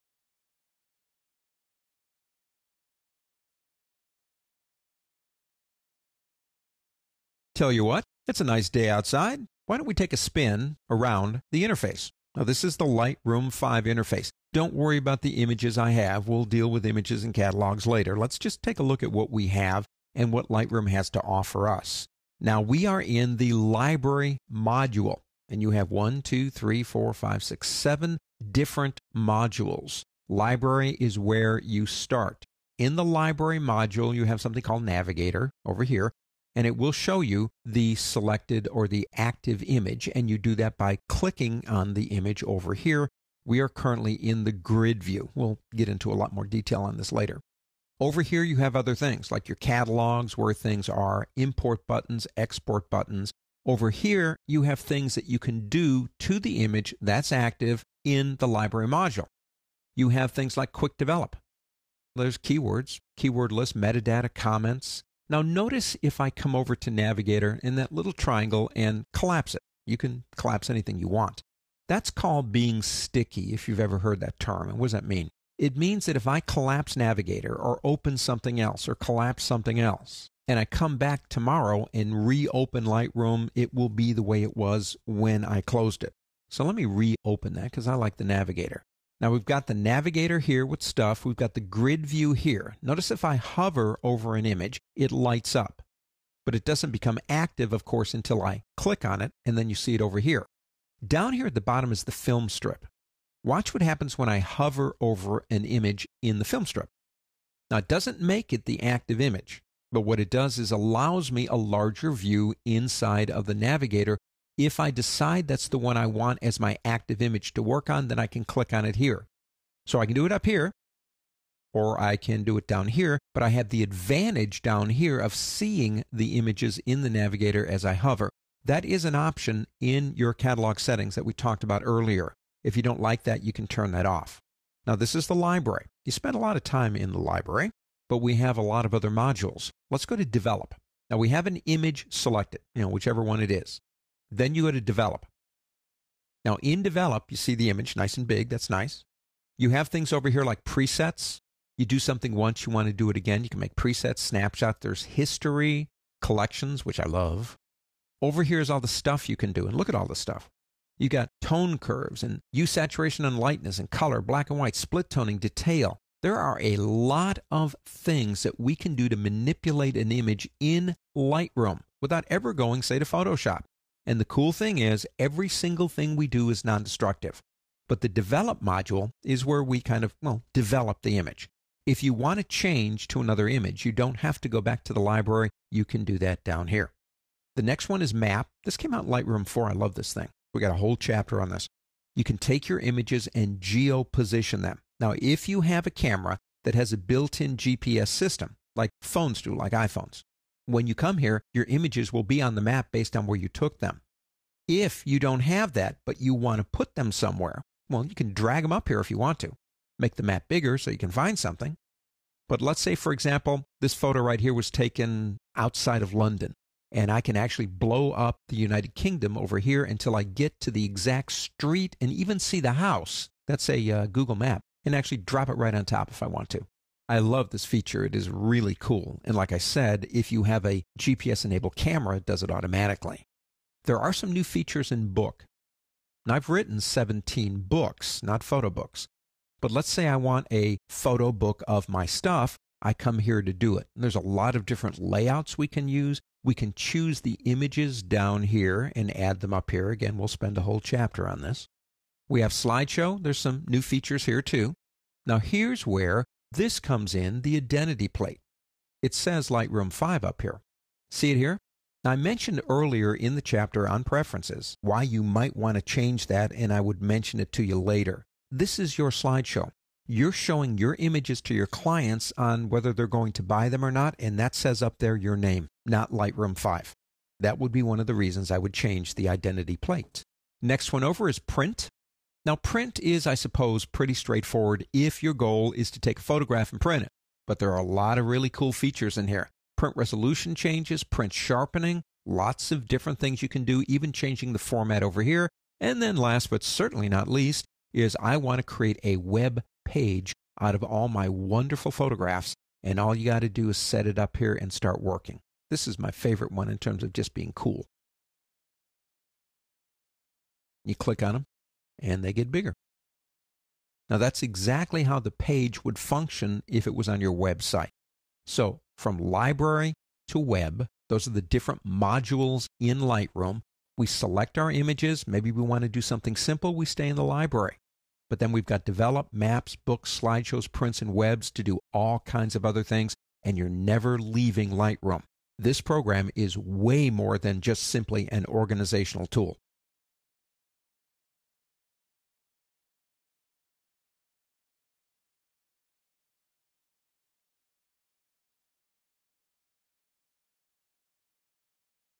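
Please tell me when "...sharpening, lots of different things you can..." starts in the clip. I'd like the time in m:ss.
4:51.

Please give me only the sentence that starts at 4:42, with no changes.
Now, print is, I suppose, pretty straightforward if your goal is to take a photograph and print it.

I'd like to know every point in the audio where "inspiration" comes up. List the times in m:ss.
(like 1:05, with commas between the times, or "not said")
not said.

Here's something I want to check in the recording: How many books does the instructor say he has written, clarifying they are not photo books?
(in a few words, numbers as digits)
17.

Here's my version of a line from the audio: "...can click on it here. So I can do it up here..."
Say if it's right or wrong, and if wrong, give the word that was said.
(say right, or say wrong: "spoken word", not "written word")
right.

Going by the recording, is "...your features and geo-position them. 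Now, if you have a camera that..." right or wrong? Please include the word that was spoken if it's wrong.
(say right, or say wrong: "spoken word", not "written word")
wrong: "images", not "features".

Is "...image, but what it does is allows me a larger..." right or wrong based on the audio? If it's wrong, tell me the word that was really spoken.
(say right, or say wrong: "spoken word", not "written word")
right.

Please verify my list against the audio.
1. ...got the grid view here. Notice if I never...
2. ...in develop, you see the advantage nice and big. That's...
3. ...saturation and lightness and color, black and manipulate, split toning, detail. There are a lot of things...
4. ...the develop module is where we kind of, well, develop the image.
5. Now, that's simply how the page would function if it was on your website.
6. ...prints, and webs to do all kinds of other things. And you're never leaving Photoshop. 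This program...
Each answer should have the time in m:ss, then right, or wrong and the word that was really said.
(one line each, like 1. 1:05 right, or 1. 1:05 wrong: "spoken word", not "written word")
1. 1:31 wrong: "hover", not "never"
2. 2:26 wrong: "image", not "advantage"
3. 2:42 wrong: "white", not "manipulate"
4. 2:58 right
5. 5:14 wrong: "exactly", not "simply"
6. 5:30 wrong: "Lightroom", not "Photoshop".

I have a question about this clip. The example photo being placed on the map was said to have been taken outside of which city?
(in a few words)
London.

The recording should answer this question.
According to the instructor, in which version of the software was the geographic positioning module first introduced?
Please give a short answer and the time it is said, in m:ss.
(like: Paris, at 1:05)
Lightroom 4, at 3:09.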